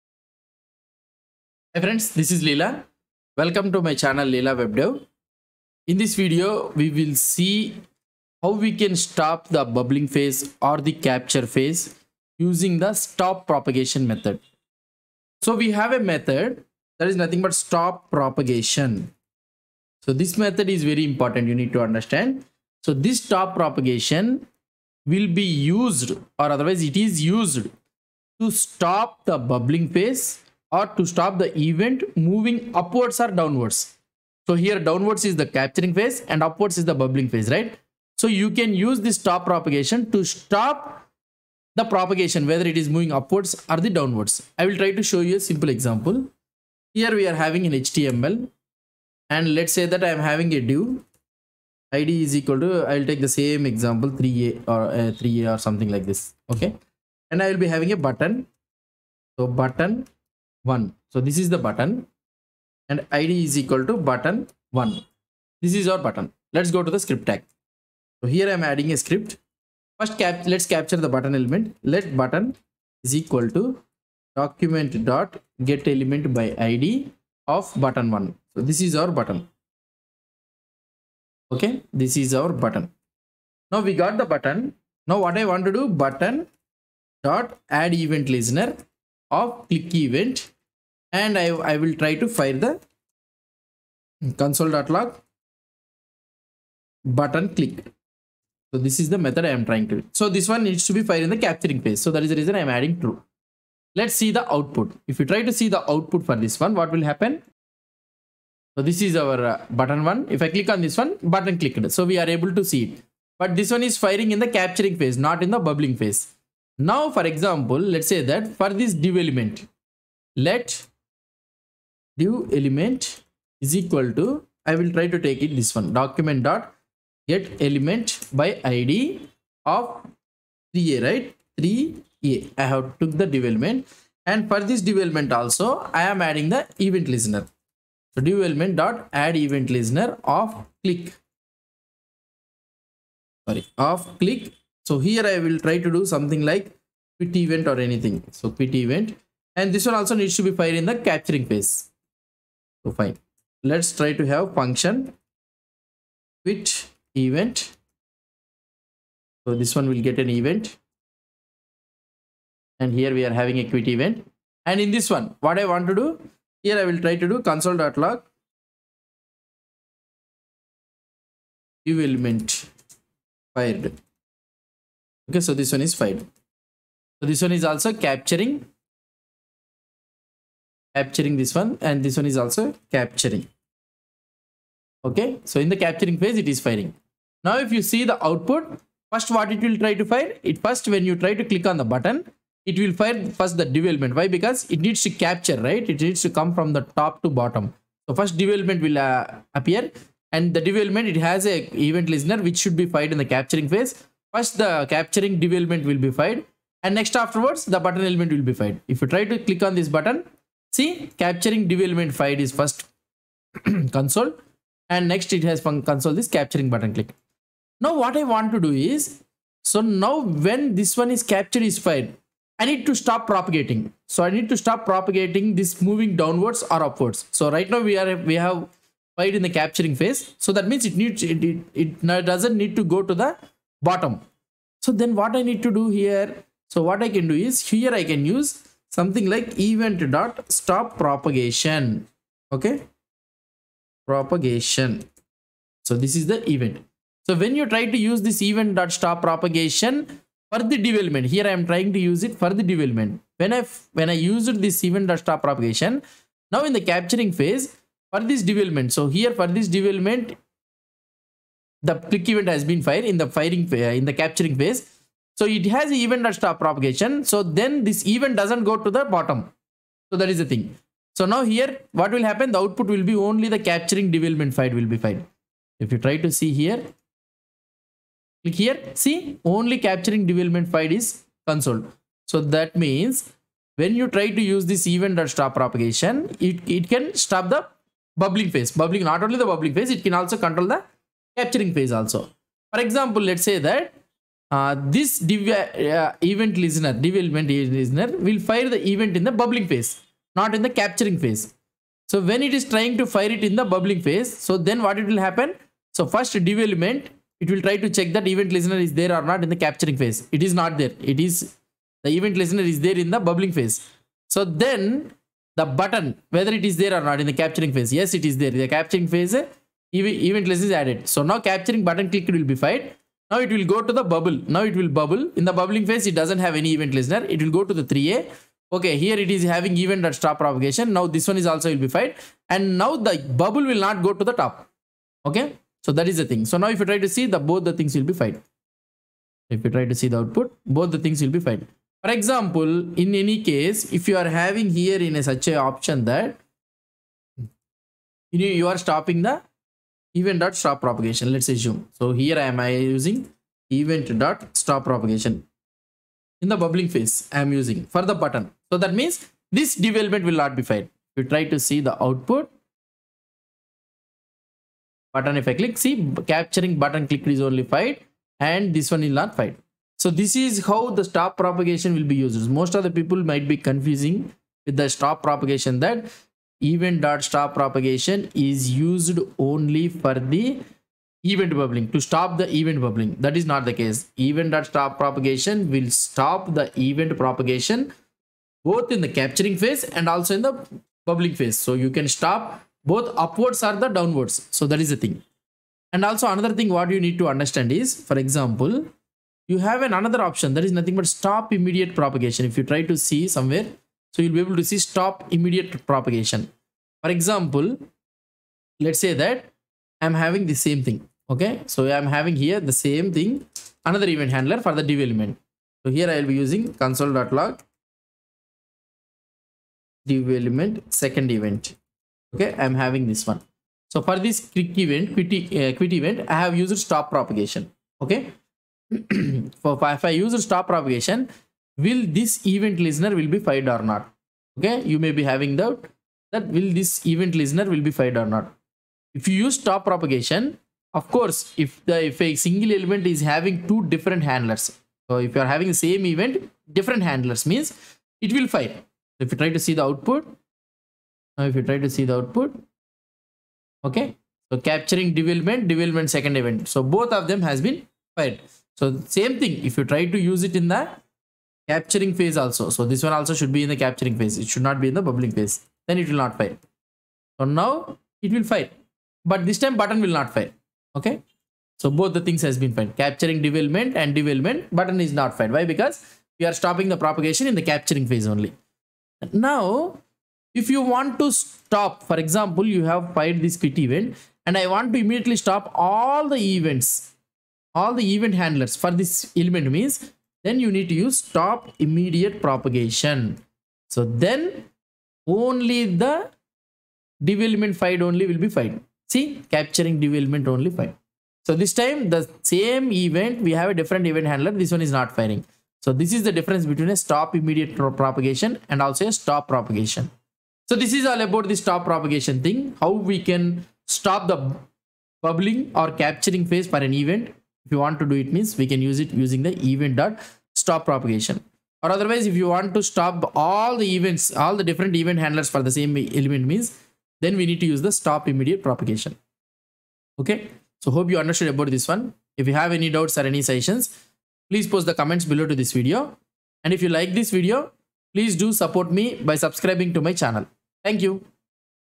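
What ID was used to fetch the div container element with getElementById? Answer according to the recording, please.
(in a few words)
3a.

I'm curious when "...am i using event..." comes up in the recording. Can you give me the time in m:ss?
5:52.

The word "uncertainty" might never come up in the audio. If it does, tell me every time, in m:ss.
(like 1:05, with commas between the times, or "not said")
not said.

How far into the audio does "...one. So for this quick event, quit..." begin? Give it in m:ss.
7:03.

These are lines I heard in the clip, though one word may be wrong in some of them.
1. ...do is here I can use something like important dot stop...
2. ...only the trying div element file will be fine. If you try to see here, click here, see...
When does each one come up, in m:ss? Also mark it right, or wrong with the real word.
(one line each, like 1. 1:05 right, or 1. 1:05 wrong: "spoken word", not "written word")
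1. 3:57 wrong: "event", not "important"
2. 4:33 wrong: "capturing", not "trying".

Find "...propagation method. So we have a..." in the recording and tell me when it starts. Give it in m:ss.
0:13.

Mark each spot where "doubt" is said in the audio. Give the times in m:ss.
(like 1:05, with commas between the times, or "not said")
7:15, 8:52.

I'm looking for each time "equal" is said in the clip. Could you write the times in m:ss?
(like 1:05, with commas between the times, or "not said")
0:52, 1:03, 1:13, 2:03.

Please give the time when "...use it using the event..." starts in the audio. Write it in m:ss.
8:38.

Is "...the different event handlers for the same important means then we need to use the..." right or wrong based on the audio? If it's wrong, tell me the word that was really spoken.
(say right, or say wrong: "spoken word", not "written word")
wrong: "element", not "important".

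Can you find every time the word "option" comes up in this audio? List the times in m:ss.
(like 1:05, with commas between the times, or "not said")
5:45, 6:40.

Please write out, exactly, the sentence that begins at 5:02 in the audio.
So when it is trying to fire it in the bubbling phase, so then what it will happen?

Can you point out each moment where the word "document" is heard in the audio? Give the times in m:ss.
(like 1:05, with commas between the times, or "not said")
1:14, 2:05.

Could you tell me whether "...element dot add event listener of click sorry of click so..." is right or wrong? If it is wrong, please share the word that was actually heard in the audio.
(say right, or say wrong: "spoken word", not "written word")
right.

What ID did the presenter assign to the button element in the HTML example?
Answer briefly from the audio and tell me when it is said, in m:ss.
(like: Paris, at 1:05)
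button 1, at 1:03.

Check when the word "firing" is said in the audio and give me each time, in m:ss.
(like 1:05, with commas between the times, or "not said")
1:53, 3:06, 4:23, 8:25.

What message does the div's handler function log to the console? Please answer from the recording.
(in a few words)
div element fired.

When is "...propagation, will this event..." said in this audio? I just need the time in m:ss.
7:10.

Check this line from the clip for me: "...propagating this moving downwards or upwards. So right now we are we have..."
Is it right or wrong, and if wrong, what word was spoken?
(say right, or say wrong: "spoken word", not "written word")
right.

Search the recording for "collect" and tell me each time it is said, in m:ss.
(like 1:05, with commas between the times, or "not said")
not said.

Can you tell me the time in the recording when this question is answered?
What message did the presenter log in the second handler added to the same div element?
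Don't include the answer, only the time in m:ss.
6:56.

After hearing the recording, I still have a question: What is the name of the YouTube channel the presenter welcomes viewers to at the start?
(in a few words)
Leela WebDev.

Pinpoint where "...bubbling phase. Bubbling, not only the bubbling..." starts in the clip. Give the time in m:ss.
4:48.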